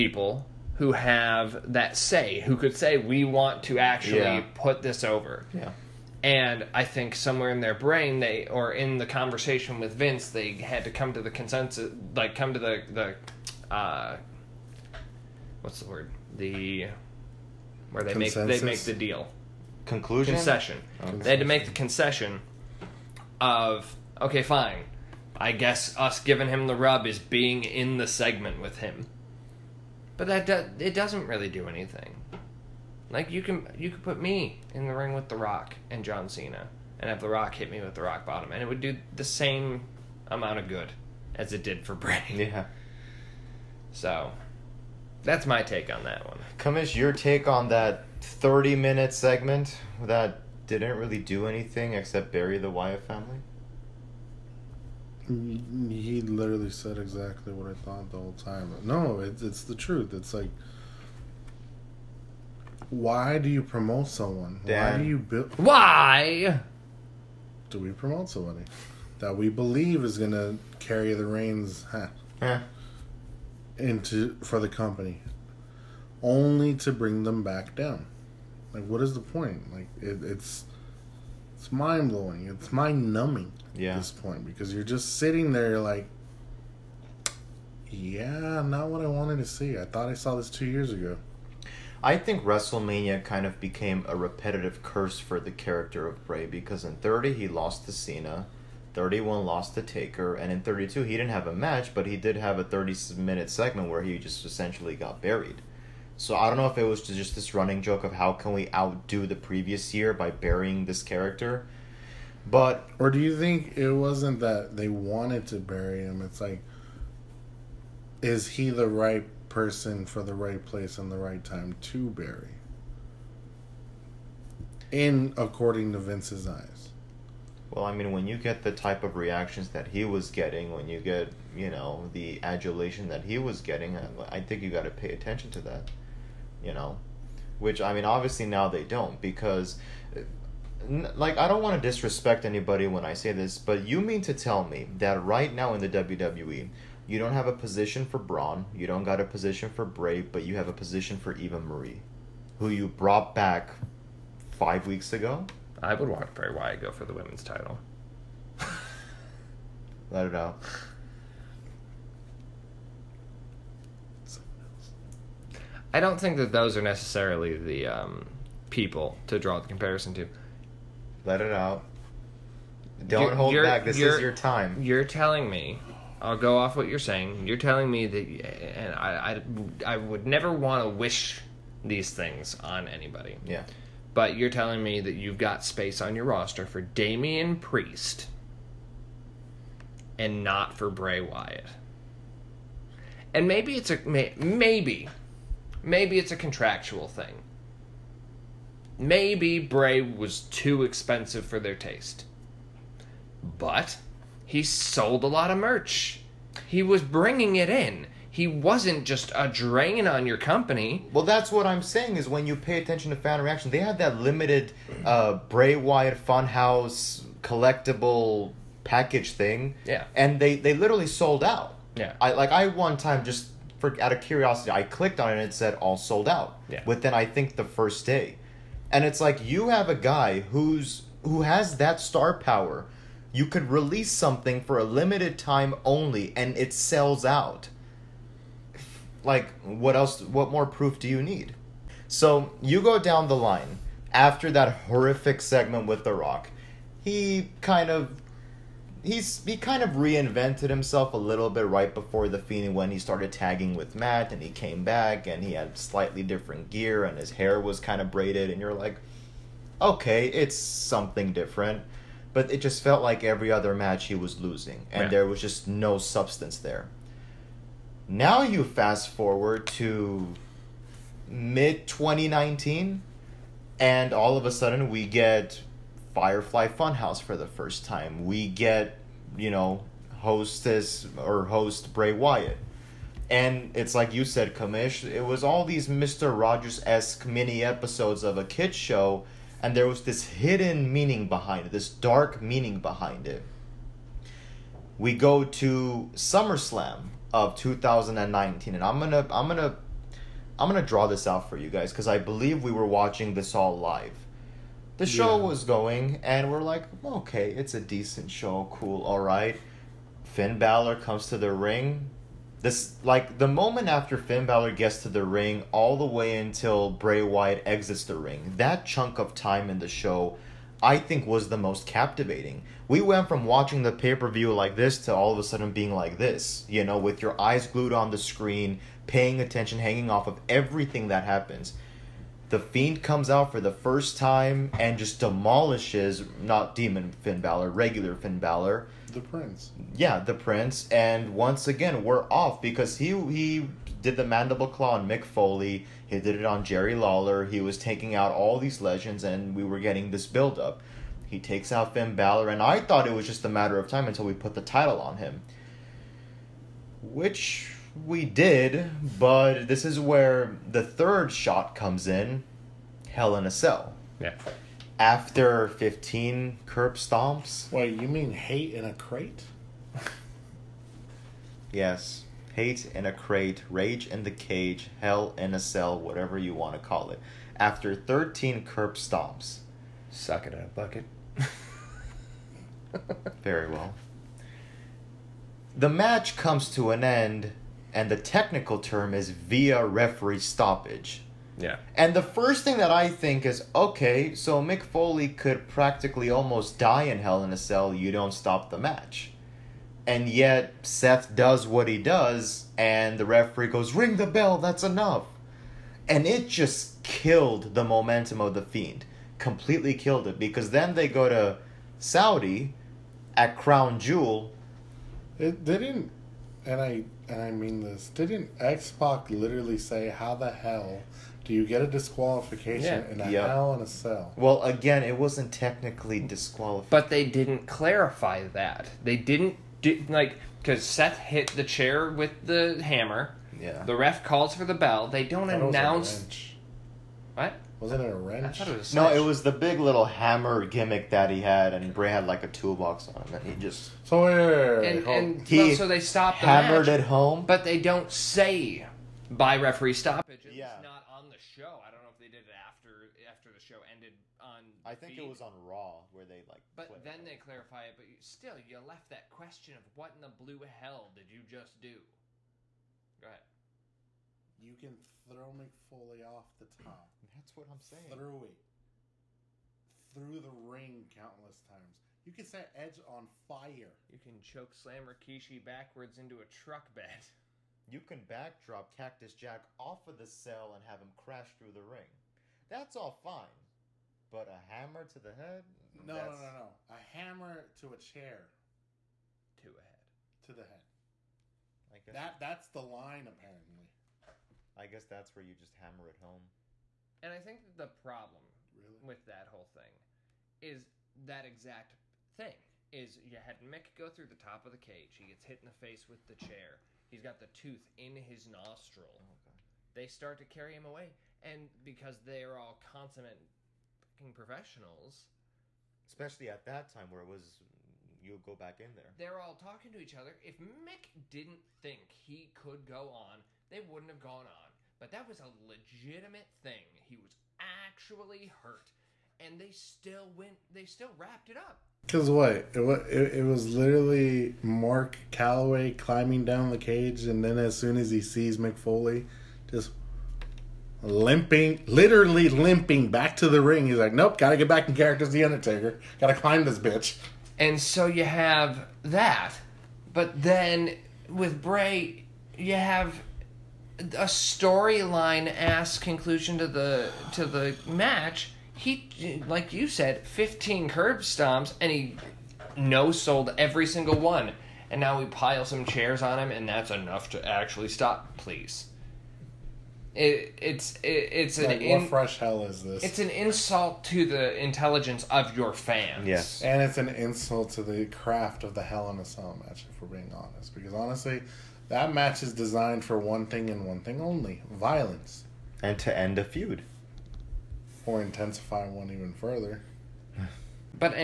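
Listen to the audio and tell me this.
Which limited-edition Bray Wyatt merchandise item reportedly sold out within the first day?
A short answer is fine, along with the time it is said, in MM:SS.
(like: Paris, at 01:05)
Funhouse collectible package, at 03:36.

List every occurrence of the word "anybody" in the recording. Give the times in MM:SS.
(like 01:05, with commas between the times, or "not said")
02:22, 03:02.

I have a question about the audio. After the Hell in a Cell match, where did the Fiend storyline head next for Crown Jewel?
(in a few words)
Saudi.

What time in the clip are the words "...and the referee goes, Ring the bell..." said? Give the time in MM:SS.
06:42.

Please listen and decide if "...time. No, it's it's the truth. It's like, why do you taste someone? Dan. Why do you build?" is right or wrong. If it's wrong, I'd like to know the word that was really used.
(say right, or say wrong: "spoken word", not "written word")
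wrong: "promote", not "taste".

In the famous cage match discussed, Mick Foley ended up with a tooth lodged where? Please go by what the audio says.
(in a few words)
His nostril.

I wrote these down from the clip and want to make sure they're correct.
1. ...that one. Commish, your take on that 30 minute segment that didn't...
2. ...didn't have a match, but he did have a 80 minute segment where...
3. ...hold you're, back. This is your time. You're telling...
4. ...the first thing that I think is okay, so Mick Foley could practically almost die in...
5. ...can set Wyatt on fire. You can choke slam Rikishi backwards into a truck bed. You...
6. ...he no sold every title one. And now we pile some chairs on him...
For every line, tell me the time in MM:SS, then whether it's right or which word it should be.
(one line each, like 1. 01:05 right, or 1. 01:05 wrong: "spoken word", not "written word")
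1. 00:46 right
2. 01:41 wrong: "30", not "80"
3. 02:53 right
4. 06:32 right
5. 07:52 wrong: "Edge", not "Wyatt"
6. 09:21 wrong: "single", not "title".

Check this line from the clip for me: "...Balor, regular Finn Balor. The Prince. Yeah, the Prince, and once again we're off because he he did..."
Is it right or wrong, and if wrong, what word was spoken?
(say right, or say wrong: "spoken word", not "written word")
right.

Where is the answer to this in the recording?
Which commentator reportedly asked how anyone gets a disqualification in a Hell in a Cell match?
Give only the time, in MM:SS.
06:58.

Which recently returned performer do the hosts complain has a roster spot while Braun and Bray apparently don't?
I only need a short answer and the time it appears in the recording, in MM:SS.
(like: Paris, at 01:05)
Eva Marie, at 02:31.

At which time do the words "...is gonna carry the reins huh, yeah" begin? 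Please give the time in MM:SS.
01:10.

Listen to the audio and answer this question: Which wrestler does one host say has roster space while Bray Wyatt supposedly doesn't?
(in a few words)
Damian Priest.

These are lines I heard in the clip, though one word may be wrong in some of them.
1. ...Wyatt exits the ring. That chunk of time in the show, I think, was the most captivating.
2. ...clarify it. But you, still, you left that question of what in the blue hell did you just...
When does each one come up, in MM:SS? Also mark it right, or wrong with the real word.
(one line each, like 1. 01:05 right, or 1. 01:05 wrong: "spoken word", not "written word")
1. 05:17 right
2. 07:37 right.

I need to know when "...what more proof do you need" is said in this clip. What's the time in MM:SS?
04:00.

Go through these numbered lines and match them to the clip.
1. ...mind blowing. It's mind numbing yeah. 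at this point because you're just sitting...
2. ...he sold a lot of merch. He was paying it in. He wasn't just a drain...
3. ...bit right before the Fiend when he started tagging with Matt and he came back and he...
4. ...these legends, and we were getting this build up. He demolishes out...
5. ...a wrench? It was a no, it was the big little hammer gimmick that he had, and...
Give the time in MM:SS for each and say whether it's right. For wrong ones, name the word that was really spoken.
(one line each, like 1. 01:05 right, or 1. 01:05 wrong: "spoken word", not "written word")
1. 01:21 right
2. 03:24 wrong: "bringing", not "paying"
3. 04:11 right
4. 05:48 wrong: "takes", not "demolishes"
5. 07:18 right.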